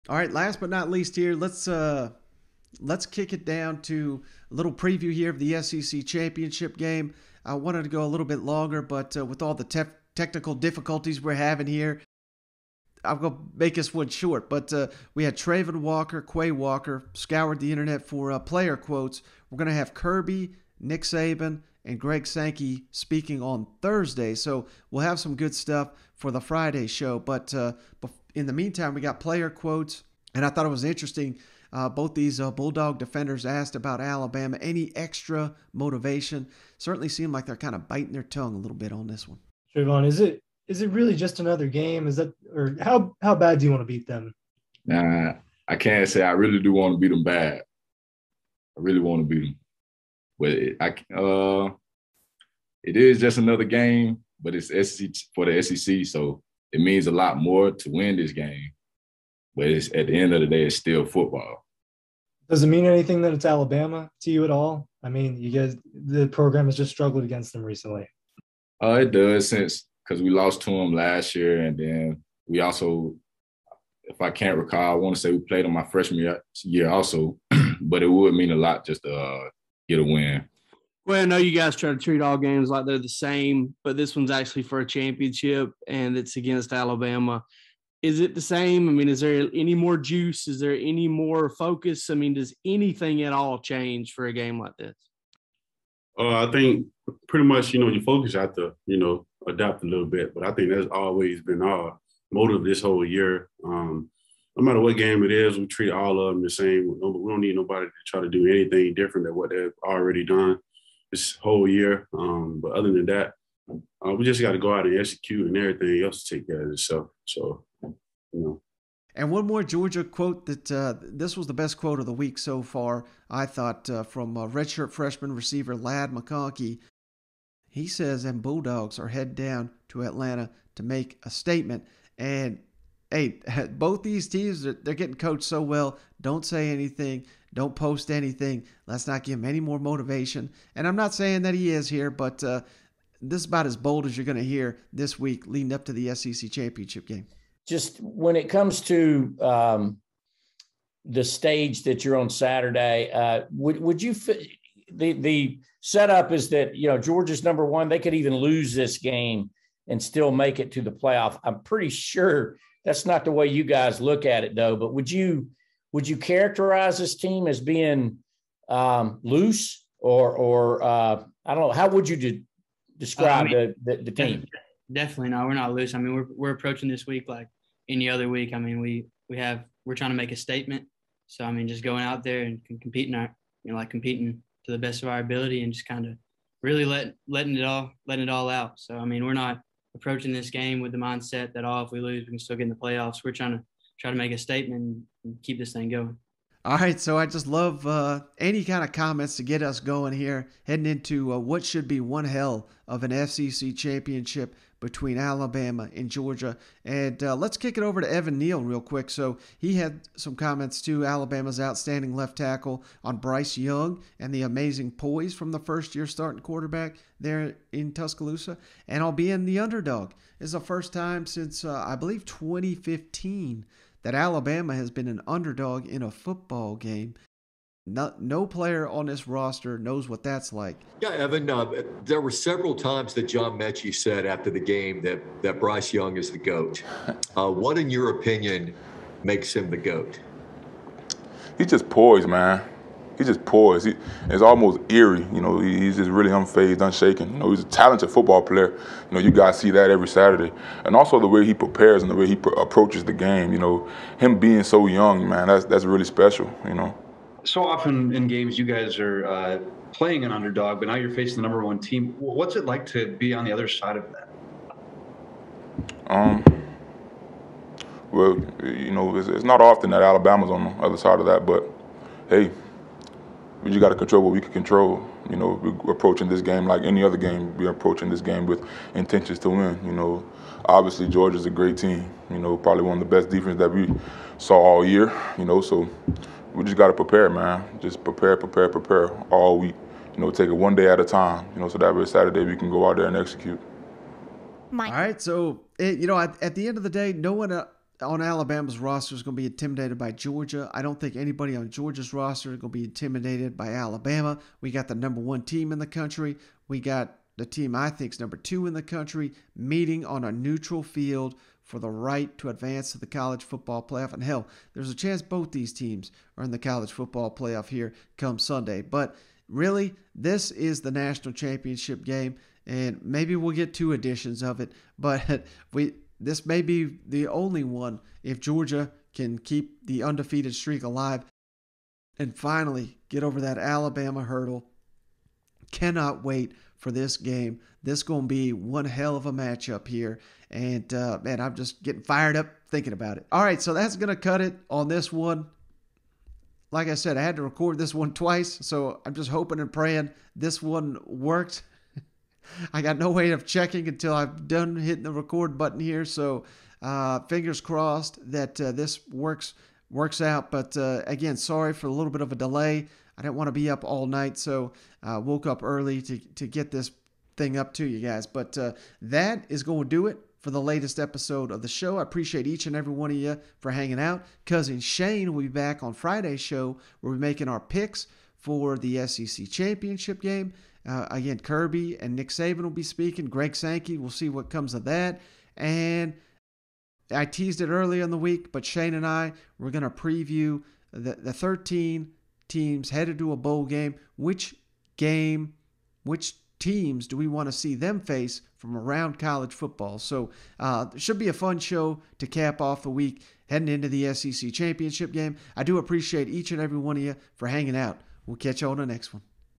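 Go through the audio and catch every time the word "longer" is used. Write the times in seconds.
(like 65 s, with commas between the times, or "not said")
8 s.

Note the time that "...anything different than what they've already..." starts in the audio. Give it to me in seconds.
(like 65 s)
108 s.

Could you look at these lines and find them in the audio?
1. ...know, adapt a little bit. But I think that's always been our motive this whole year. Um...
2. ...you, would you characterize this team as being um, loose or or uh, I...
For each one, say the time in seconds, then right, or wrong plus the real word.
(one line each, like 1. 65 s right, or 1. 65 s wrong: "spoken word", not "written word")
1. 98 s right
2. 165 s right.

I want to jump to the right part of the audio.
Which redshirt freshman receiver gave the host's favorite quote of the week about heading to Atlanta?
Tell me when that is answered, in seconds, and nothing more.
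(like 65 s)
125 s.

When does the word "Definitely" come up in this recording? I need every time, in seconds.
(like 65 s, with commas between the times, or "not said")
174 s.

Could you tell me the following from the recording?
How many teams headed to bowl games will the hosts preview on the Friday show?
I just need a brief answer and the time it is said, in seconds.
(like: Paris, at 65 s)
13, at 391 s.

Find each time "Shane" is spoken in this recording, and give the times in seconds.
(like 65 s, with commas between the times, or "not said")
374 s, 388 s.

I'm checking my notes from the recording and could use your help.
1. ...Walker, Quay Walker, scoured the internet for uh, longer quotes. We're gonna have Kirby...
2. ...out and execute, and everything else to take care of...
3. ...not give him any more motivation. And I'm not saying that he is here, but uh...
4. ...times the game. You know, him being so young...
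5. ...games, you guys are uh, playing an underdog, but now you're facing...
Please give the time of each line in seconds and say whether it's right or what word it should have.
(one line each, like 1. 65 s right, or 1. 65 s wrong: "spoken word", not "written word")
1. 15 s wrong: "player", not "longer"
2. 114 s right
3. 139 s right
4. 252 s wrong: "approaches", not "times"
5. 258 s right.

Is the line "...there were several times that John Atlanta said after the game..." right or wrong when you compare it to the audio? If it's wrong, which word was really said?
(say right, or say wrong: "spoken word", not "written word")
wrong: "Metchie", not "Atlanta".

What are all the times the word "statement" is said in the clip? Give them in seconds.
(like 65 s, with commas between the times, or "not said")
131 s, 180 s, 194 s.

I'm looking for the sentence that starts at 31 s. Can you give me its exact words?
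Uh, both these uh, Bulldog defenders asked about Alabama.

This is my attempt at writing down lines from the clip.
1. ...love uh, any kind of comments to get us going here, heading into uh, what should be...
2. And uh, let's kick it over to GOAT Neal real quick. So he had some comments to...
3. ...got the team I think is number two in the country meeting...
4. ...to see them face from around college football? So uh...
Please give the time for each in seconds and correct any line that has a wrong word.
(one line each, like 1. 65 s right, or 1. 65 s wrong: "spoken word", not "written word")
1. 197 s right
2. 206 s wrong: "Evan", not "GOAT"
3. 306 s right
4. 397 s right.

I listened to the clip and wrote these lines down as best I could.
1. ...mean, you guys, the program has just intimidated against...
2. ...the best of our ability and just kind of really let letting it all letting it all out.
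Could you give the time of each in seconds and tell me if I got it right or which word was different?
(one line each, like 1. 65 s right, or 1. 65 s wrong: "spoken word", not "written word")
1. 65 s wrong: "struggled", not "intimidated"
2. 184 s right.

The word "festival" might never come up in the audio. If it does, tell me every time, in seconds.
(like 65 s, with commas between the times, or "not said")
not said.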